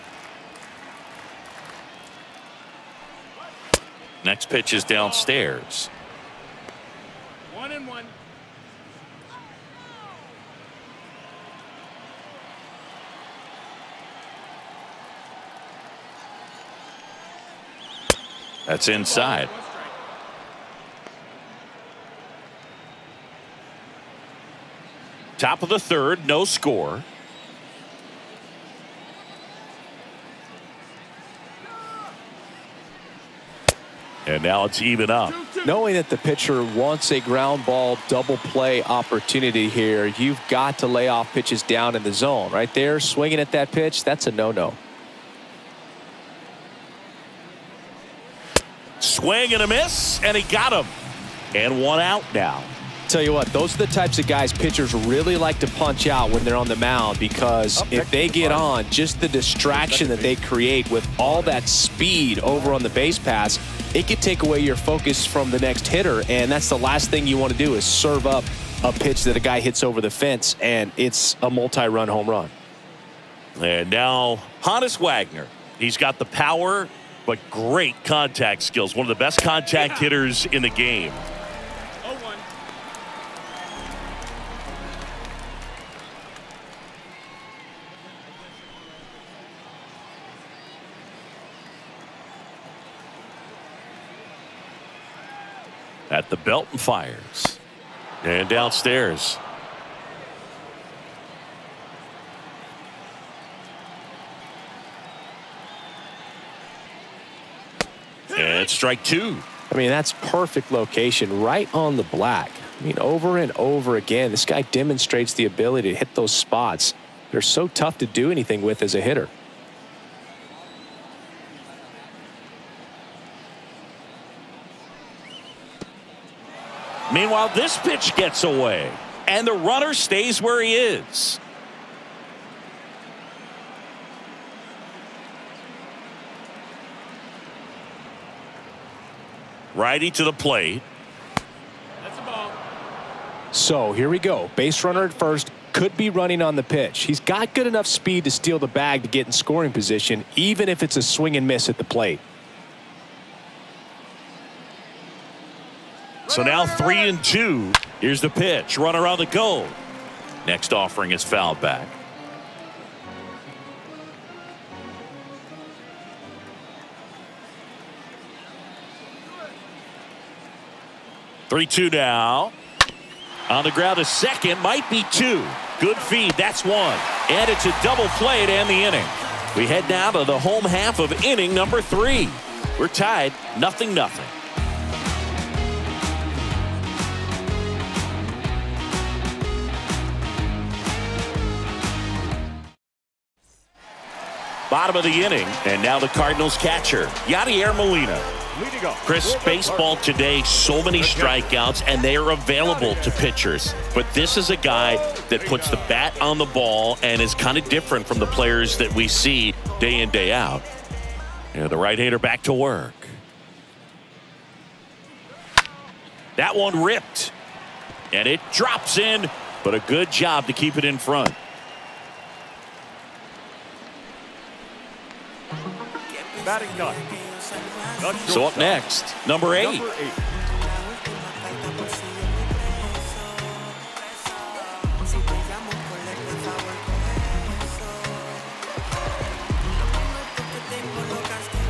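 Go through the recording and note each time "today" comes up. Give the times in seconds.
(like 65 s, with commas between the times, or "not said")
199 s.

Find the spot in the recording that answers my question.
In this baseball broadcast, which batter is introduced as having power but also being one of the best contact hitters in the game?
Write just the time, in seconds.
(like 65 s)
74 s.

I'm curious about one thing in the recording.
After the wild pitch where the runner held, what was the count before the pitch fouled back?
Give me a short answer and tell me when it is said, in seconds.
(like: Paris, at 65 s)
3 and 2, at 156 s.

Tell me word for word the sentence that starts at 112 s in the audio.
I mean, over and over again, this guy demonstrates the ability to hit those spots.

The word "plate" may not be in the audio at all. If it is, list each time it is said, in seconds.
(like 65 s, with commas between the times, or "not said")
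140 s, 151 s.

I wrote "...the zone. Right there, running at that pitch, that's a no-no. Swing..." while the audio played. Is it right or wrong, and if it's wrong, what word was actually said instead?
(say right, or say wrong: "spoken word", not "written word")
wrong: "swinging", not "running".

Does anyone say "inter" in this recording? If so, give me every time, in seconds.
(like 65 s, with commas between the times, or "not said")
not said.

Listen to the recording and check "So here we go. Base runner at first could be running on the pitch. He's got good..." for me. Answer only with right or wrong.
right.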